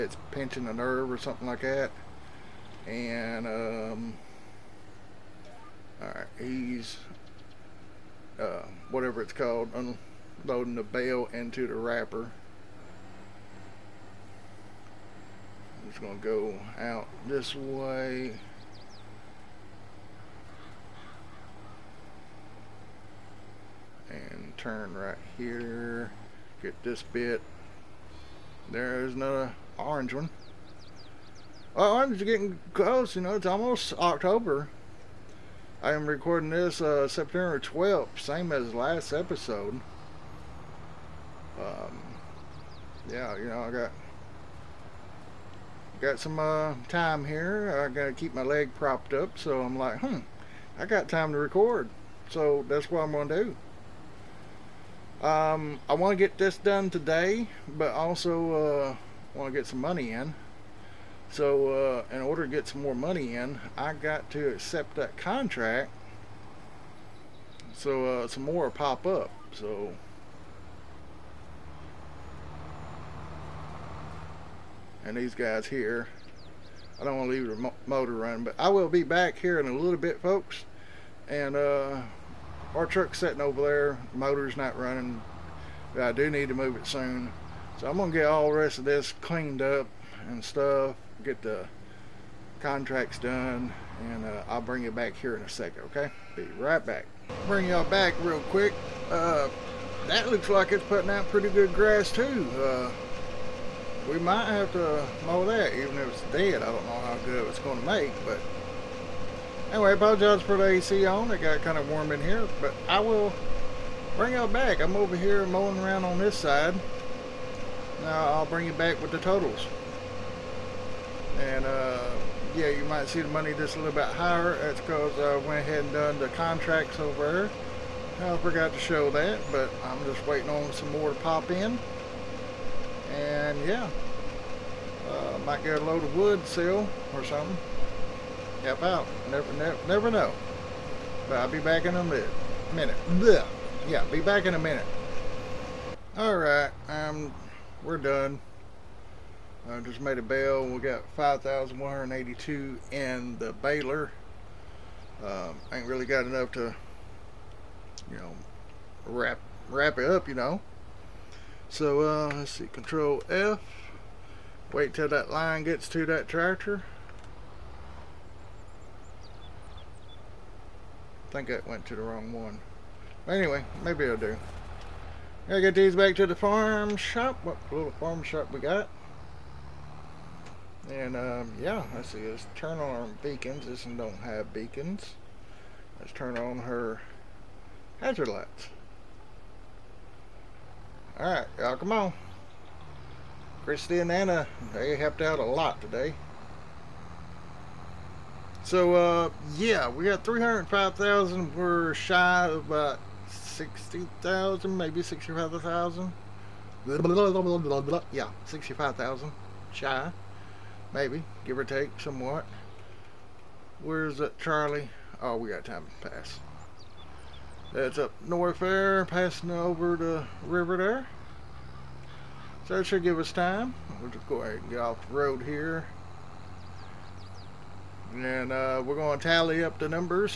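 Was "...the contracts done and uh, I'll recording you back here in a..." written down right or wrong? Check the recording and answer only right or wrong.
wrong.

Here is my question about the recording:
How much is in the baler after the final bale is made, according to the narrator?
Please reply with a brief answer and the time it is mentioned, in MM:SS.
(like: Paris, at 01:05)
5,182, at 02:31.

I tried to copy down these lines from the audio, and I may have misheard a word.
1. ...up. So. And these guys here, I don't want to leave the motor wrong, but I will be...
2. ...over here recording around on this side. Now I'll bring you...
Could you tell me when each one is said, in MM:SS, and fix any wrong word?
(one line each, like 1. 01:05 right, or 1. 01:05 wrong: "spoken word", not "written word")
1. 01:09 wrong: "running", not "wrong"
2. 01:54 wrong: "mowing", not "recording".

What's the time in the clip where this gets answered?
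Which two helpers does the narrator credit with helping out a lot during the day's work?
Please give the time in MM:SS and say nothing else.
03:13.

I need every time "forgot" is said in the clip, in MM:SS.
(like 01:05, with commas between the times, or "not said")
02:08.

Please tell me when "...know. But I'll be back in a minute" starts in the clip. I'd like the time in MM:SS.
02:20.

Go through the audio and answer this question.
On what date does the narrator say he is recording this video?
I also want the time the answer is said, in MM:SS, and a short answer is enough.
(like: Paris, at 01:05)
September 12th, at 00:37.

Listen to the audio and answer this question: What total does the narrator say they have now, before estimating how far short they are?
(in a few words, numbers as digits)
305,000.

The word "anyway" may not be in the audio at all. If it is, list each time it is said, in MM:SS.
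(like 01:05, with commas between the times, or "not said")
01:49, 02:53.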